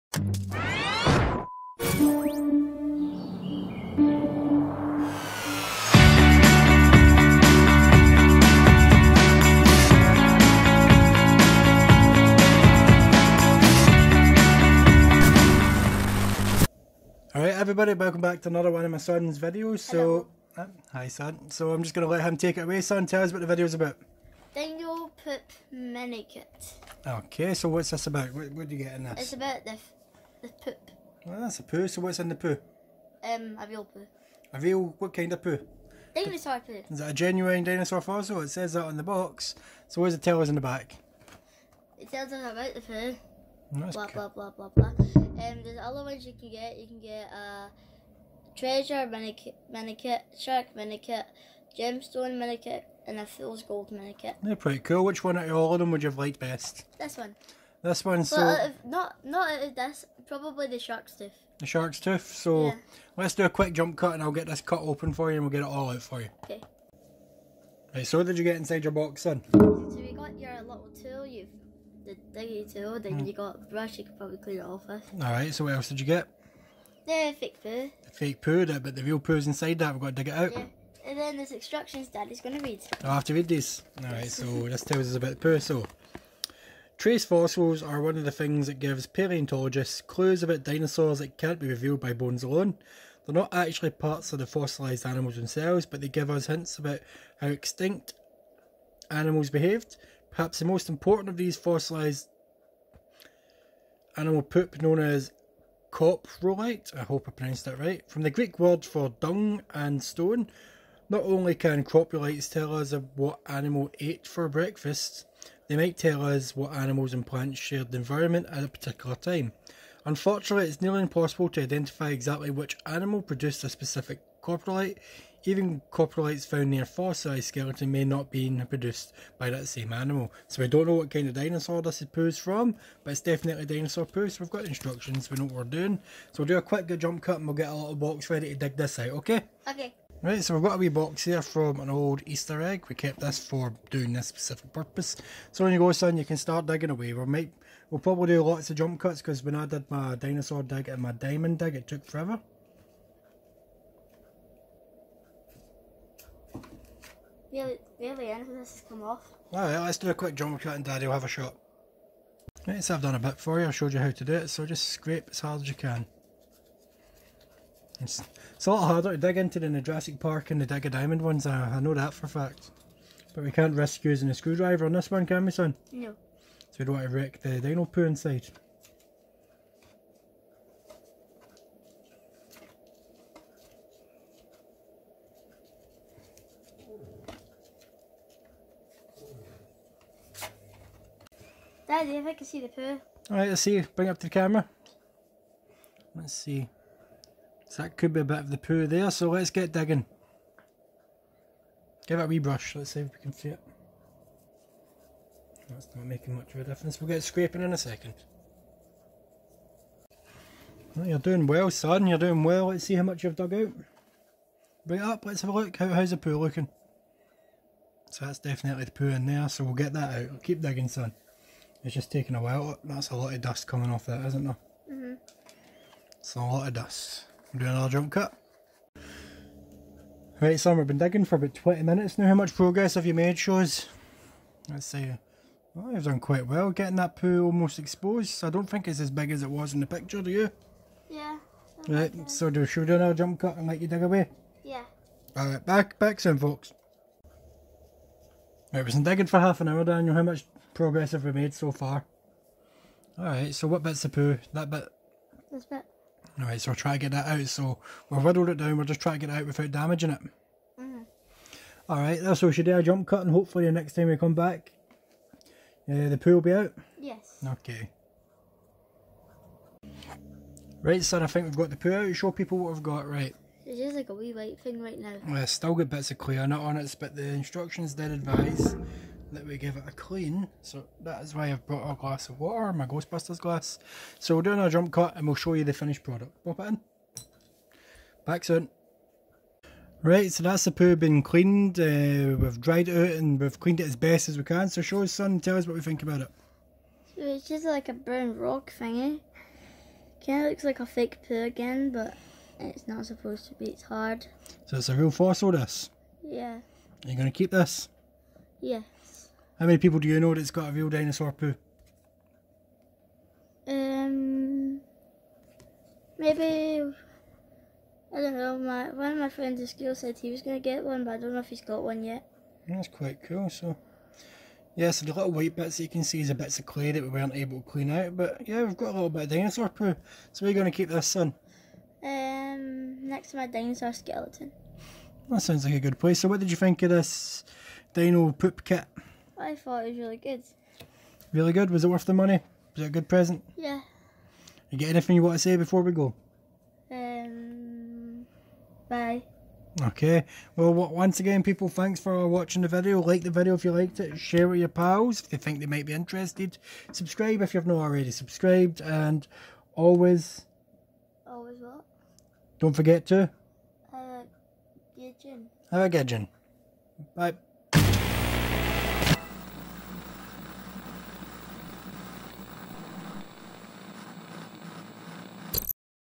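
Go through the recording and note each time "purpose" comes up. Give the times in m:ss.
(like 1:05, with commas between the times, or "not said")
2:24.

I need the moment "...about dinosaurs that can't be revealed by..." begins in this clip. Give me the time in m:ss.
1:30.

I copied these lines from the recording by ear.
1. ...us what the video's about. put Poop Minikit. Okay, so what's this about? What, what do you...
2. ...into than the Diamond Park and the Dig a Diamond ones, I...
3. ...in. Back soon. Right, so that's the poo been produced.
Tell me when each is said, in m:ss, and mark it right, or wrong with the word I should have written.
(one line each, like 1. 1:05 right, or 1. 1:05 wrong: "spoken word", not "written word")
1. 0:23 right
2. 2:49 wrong: "Jurassic", not "Diamond"
3. 4:46 wrong: "cleaned", not "produced".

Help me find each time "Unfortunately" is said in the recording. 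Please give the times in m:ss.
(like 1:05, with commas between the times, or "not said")
2:00.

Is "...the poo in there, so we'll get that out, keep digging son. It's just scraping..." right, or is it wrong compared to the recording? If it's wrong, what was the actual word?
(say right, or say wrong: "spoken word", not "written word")
wrong: "taking", not "scraping".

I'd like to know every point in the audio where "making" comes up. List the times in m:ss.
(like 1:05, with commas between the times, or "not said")
3:26.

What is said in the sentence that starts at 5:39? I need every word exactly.
I thought it was really good.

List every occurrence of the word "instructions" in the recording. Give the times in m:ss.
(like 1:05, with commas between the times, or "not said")
1:21, 2:14, 4:37.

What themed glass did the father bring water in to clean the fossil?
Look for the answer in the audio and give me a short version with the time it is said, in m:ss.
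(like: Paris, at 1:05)
Ghostbusters glass, at 4:42.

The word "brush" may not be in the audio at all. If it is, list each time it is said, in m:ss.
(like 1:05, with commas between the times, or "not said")
1:13, 3:22.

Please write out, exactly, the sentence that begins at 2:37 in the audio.
Really, really, anything this has come off.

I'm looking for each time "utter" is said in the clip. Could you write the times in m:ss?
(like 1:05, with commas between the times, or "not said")
not said.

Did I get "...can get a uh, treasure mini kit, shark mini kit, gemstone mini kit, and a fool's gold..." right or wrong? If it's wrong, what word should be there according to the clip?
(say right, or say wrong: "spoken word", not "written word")
right.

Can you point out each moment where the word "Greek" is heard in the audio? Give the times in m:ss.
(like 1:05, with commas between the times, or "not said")
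1:48.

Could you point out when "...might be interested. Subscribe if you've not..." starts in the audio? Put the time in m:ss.
5:55.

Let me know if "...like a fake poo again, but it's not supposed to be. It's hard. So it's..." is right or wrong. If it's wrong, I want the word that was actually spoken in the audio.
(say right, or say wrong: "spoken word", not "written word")
right.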